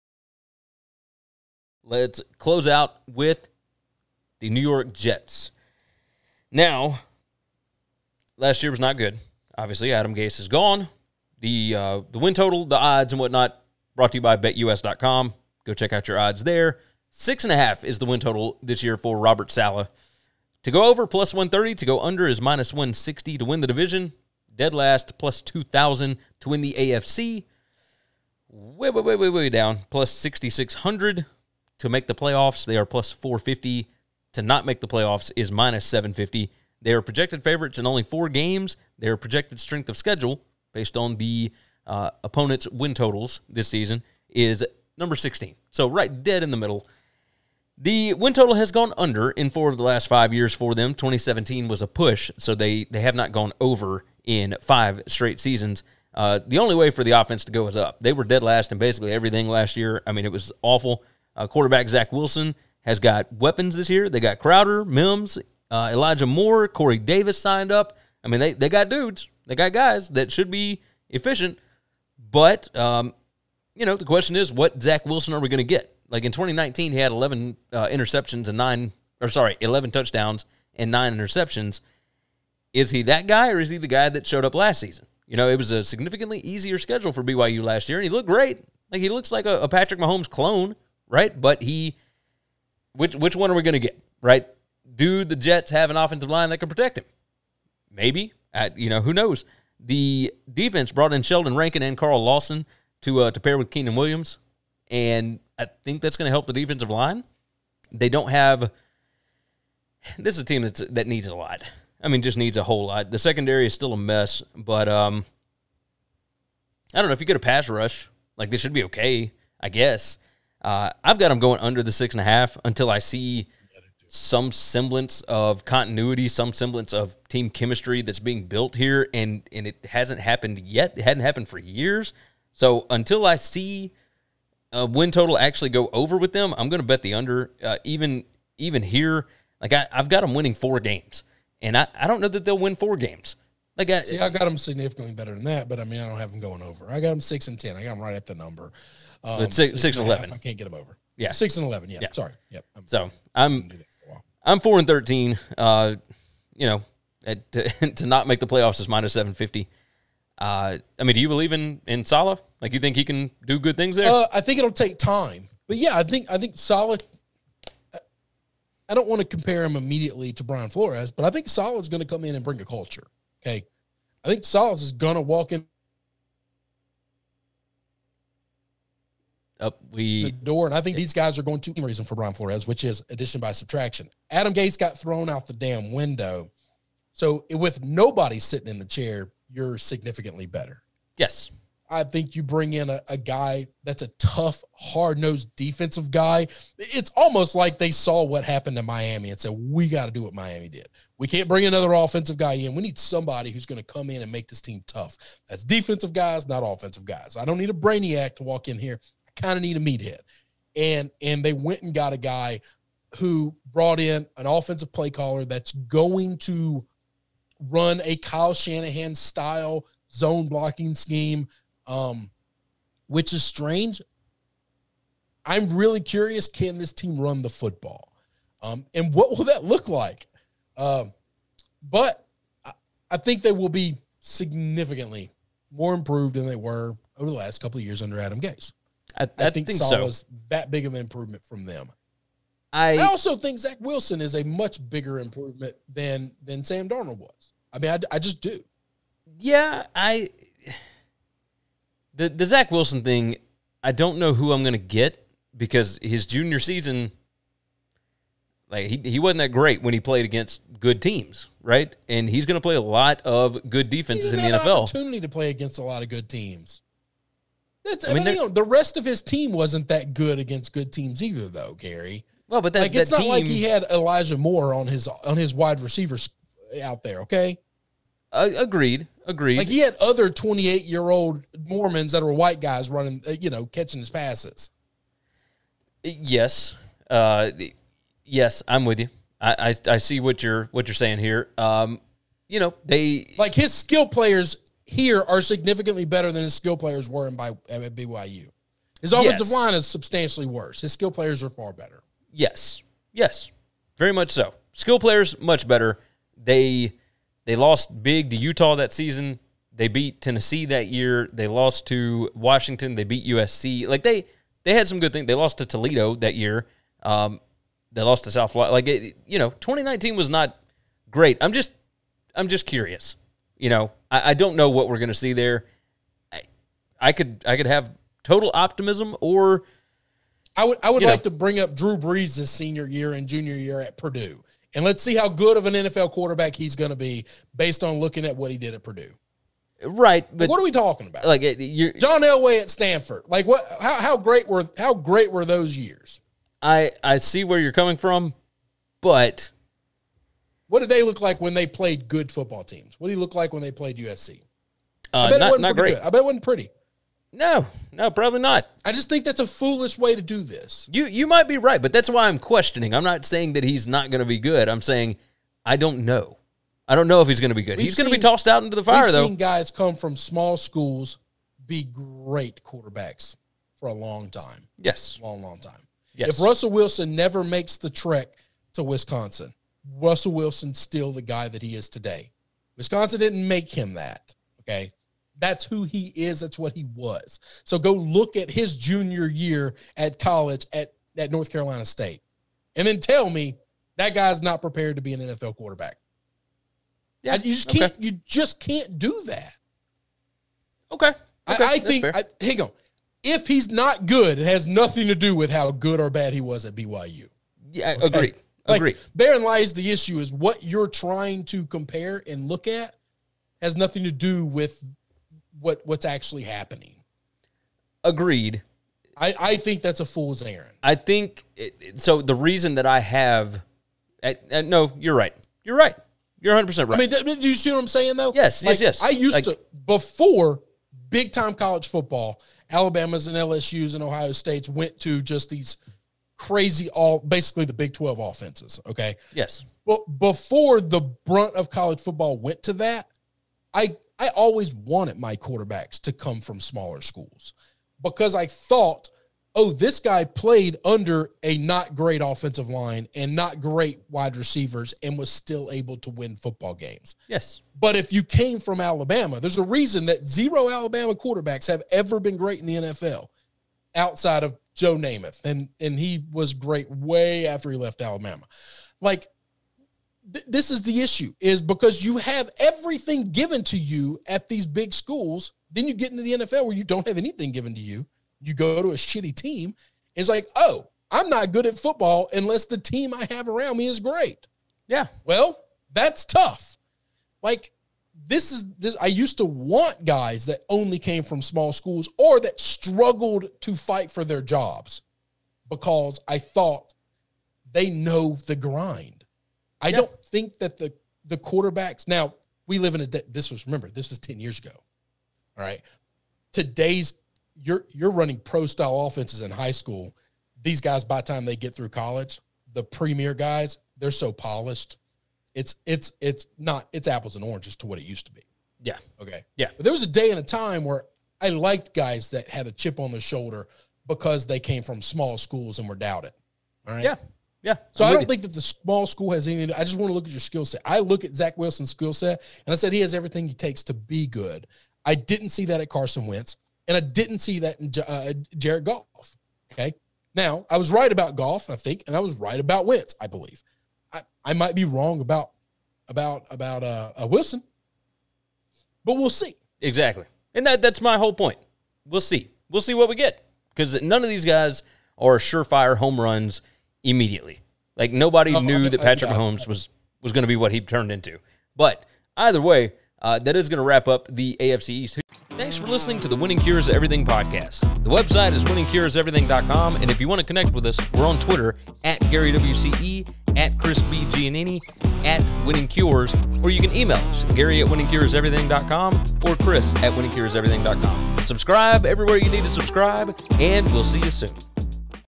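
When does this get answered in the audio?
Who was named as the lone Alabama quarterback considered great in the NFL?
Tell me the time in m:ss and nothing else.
7:44.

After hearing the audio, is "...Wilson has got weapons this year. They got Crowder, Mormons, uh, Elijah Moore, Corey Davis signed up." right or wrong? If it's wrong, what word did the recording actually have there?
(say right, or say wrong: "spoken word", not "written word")
wrong: "Mims", not "Mormons".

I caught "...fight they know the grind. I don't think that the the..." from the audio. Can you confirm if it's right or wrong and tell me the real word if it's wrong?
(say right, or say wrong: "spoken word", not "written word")
wrong: "thought", not "fight".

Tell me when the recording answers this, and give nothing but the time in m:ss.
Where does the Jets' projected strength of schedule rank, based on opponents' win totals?
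0:44.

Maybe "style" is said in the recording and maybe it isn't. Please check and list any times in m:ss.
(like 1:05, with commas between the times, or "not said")
3:39, 8:28.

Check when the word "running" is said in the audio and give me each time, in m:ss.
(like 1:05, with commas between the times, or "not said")
4:42, 8:28.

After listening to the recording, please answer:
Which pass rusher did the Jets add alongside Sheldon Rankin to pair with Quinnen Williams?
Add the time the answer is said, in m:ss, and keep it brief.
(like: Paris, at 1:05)
Carl Lawson, at 1:41.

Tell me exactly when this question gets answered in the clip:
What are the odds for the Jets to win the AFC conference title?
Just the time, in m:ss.
0:29.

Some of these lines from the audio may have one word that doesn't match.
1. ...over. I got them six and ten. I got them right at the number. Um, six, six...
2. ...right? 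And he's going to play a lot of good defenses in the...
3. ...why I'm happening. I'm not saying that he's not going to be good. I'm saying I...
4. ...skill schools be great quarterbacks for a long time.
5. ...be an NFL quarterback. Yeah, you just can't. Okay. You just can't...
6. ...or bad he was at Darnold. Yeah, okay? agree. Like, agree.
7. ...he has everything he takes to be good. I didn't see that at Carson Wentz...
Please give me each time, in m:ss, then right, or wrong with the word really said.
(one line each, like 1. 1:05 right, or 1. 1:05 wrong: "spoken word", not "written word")
1. 2:26 right
2. 4:21 right
3. 6:02 wrong: "questioning", not "happening"
4. 6:10 wrong: "small", not "skill"
5. 6:35 right
6. 6:45 wrong: "BYU", not "Darnold"
7. 8:52 right.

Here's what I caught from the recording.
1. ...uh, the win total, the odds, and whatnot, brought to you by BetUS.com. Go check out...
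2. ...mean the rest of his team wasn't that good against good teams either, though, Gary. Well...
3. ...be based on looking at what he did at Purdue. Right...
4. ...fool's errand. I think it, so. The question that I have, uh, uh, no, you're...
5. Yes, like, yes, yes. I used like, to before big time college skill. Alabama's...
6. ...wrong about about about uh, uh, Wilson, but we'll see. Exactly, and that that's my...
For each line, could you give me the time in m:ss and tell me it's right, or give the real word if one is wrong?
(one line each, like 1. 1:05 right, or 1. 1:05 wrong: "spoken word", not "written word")
1. 0:11 right
2. 4:28 right
3. 5:36 right
4. 7:00 wrong: "reason", not "question"
5. 7:08 wrong: "football", not "skill"
6. 9:04 right.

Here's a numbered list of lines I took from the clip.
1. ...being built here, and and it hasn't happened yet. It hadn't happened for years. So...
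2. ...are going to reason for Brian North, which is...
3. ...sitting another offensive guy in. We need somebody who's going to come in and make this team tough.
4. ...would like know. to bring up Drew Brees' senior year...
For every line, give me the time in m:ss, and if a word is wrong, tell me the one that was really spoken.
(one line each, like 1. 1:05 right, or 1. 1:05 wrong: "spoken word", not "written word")
1. 2:08 right
2. 3:01 wrong: "Flores", not "North"
3. 3:21 wrong: "bring", not "sitting"
4. 5:30 right.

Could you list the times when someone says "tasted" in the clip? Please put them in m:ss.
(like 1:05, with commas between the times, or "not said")
not said.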